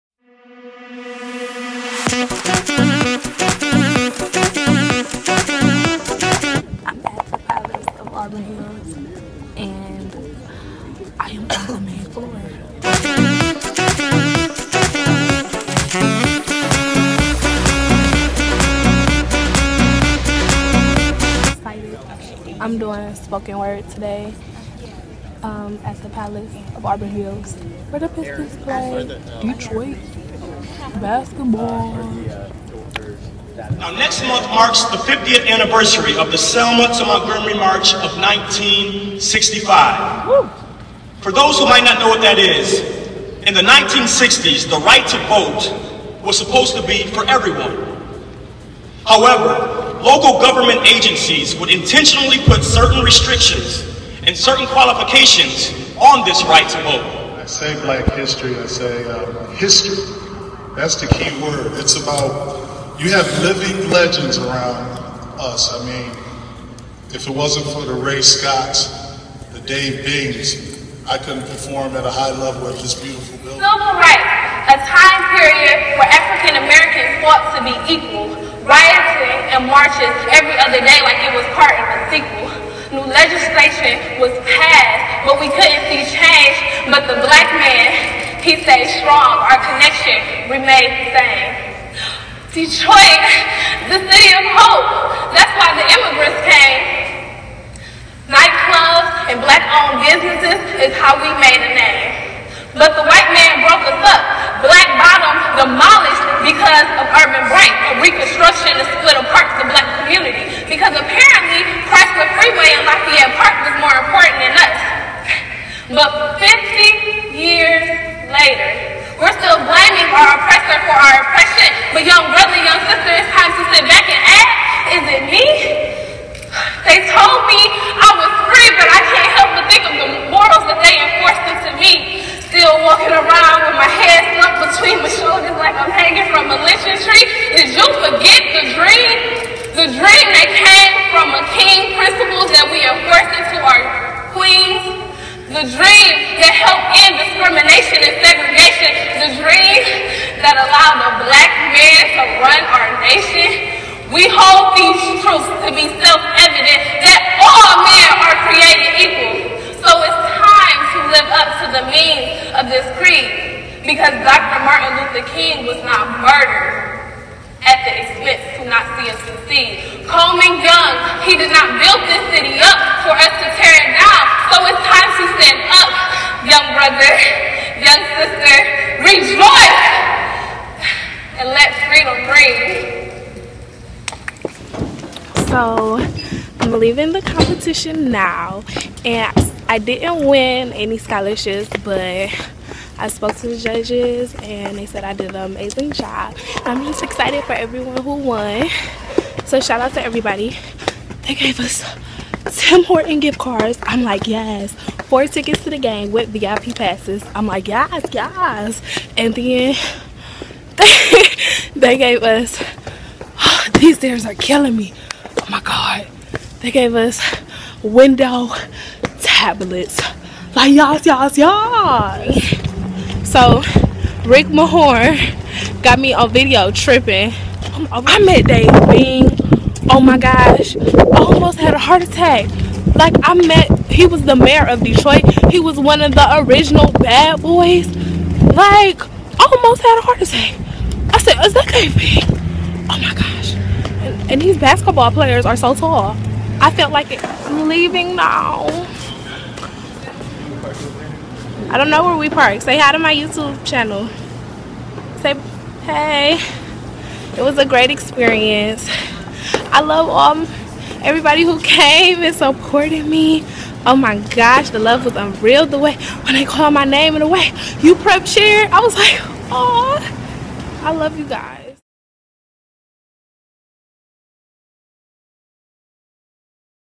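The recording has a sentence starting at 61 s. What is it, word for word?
It's about you have living legends around us.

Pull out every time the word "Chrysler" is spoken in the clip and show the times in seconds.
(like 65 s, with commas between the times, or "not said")
111 s.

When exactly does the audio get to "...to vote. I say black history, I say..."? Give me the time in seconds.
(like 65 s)
56 s.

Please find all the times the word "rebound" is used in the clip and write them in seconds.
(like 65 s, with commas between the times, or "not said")
not said.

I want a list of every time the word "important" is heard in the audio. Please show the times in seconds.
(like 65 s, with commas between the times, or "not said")
113 s.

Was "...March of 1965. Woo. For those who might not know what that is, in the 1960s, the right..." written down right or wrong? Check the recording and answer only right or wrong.
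right.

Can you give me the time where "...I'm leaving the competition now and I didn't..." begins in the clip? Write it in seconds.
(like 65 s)
186 s.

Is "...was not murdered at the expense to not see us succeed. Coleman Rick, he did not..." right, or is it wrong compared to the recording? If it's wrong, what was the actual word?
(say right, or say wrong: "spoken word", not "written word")
wrong: "Young", not "Rick".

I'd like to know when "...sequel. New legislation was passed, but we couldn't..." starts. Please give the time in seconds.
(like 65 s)
82 s.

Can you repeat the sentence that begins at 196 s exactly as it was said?
I'm just excited for everyone who won.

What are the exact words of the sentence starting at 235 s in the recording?
He was one of the original bad boys.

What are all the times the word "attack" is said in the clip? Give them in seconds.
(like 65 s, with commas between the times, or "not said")
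232 s, 240 s.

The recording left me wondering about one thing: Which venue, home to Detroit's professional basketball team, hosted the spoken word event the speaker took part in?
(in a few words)
Palace of Auburn Hills.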